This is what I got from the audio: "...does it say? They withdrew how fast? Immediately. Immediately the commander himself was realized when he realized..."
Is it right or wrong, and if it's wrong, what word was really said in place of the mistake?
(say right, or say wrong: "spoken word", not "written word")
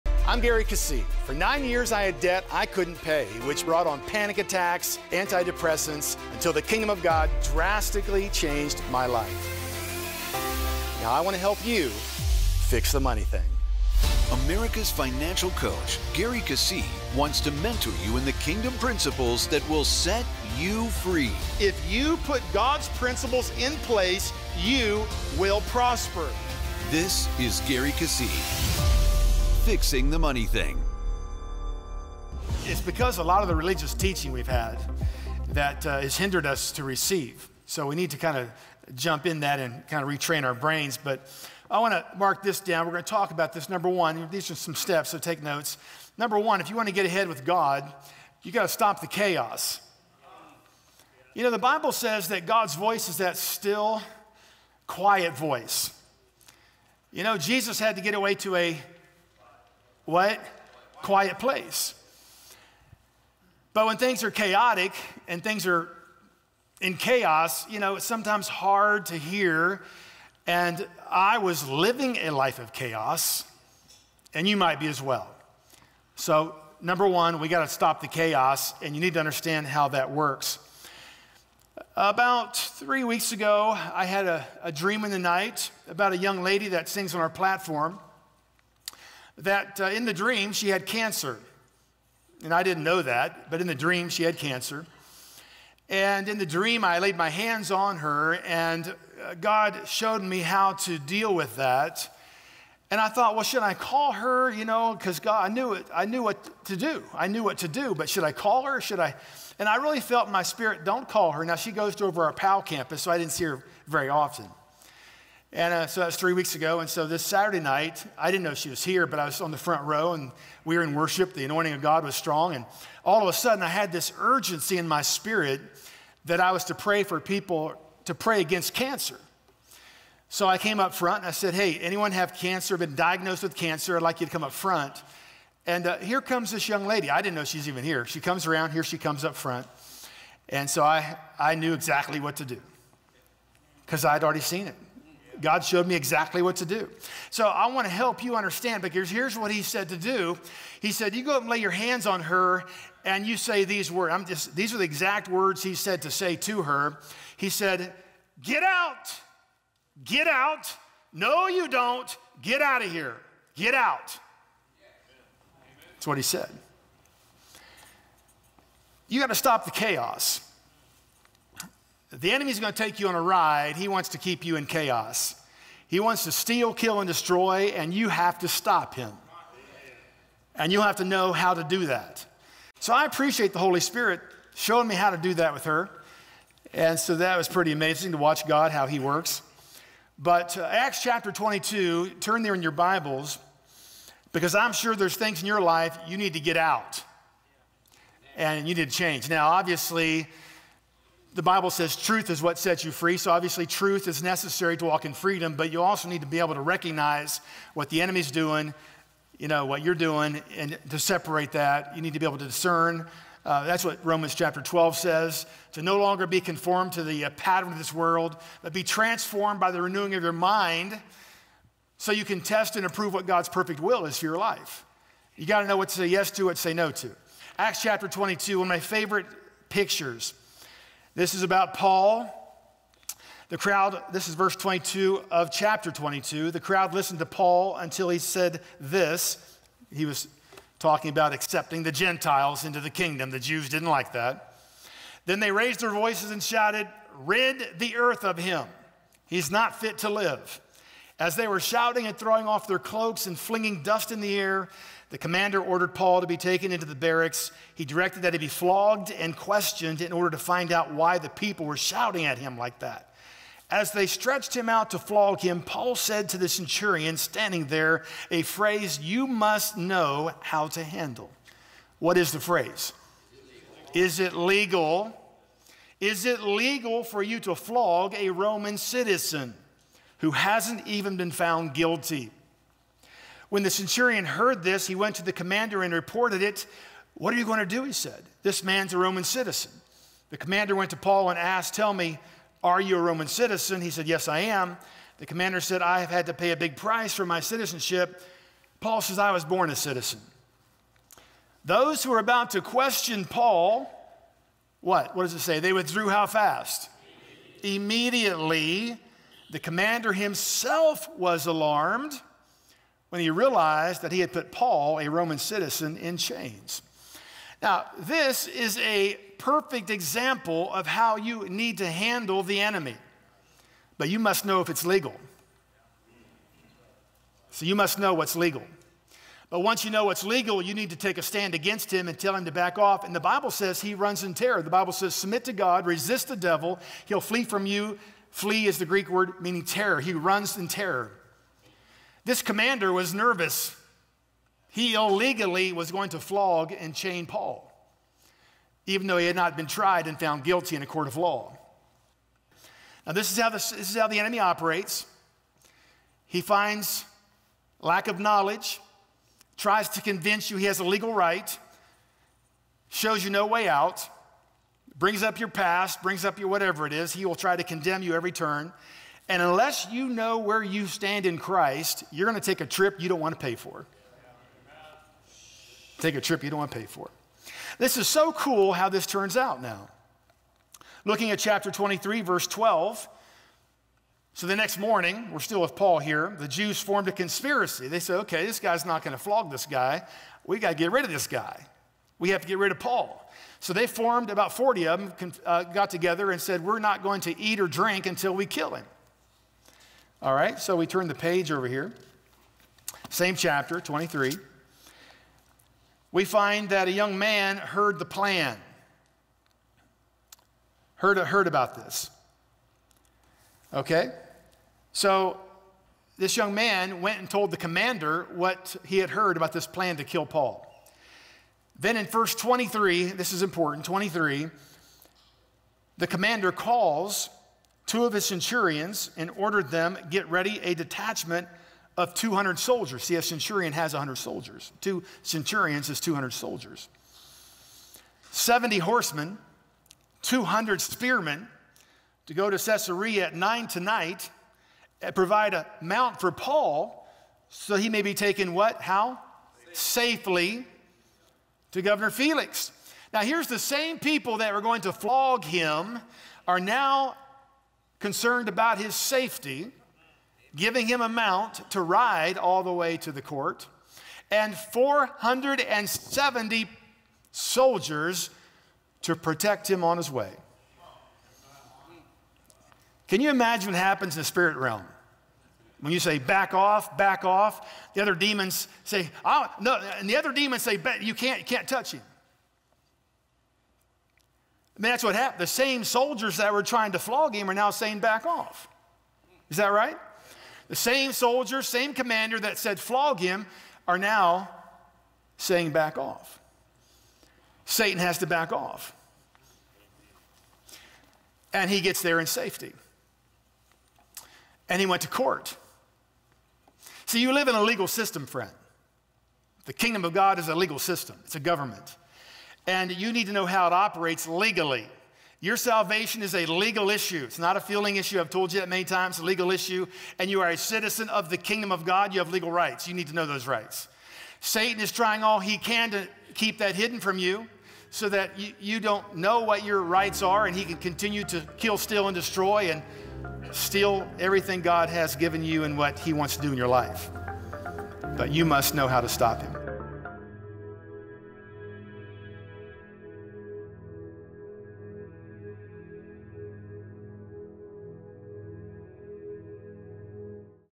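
wrong: "alarmed", not "realized".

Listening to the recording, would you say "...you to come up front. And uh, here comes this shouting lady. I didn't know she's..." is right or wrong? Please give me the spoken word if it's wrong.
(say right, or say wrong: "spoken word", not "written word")
wrong: "young", not "shouting".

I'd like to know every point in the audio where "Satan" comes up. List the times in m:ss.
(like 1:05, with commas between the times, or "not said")
8:17, 8:44.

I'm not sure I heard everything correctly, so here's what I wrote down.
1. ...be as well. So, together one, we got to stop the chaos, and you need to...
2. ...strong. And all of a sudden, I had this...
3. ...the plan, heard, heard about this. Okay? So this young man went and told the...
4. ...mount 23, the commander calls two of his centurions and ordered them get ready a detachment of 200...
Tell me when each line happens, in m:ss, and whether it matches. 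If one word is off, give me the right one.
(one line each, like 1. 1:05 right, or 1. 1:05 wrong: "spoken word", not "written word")
1. 1:14 wrong: "number", not "together"
2. 2:02 right
3. 6:47 right
4. 7:03 wrong: "important", not "mount".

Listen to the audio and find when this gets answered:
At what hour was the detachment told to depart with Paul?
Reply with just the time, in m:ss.
7:23.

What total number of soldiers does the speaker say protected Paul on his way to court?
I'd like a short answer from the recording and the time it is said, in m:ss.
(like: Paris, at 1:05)
470, at 7:44.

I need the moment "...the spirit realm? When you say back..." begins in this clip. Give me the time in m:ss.
7:54.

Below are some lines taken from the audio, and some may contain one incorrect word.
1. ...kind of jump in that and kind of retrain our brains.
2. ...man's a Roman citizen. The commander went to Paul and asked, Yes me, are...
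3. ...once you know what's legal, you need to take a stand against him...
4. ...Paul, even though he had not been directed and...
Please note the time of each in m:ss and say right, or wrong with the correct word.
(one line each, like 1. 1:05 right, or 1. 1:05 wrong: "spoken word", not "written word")
1. 0:38 right
2. 4:48 wrong: "Tell", not "Yes"
3. 5:29 right
4. 5:47 wrong: "tried", not "directed".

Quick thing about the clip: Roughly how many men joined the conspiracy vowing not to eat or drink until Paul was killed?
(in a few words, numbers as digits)
About 40.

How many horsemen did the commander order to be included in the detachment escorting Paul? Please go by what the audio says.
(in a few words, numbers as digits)
70.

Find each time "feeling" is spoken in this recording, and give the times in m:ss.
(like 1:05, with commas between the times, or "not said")
8:37.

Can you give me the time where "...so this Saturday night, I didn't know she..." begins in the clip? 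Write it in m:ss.
1:56.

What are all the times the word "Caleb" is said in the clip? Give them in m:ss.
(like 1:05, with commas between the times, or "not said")
not said.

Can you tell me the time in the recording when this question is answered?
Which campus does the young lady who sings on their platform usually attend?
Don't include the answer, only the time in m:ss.
1:52.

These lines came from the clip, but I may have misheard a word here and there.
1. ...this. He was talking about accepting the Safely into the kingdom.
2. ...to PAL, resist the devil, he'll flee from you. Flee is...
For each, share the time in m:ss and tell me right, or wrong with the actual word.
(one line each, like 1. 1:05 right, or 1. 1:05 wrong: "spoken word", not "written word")
1. 3:58 wrong: "Gentiles", not "Safely"
2. 5:35 wrong: "God", not "PAL".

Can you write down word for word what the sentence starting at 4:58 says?
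Paul says, I was born a citizen.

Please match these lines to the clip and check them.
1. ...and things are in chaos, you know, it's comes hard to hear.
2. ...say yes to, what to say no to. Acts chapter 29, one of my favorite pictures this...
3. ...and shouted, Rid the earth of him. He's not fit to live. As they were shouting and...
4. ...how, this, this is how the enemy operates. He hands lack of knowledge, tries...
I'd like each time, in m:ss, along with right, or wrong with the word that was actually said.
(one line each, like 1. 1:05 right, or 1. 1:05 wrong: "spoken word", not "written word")
1. 1:05 wrong: "sometimes", not "comes"
2. 3:45 wrong: "22", not "29"
3. 4:06 right
4. 5:53 wrong: "finds", not "hands".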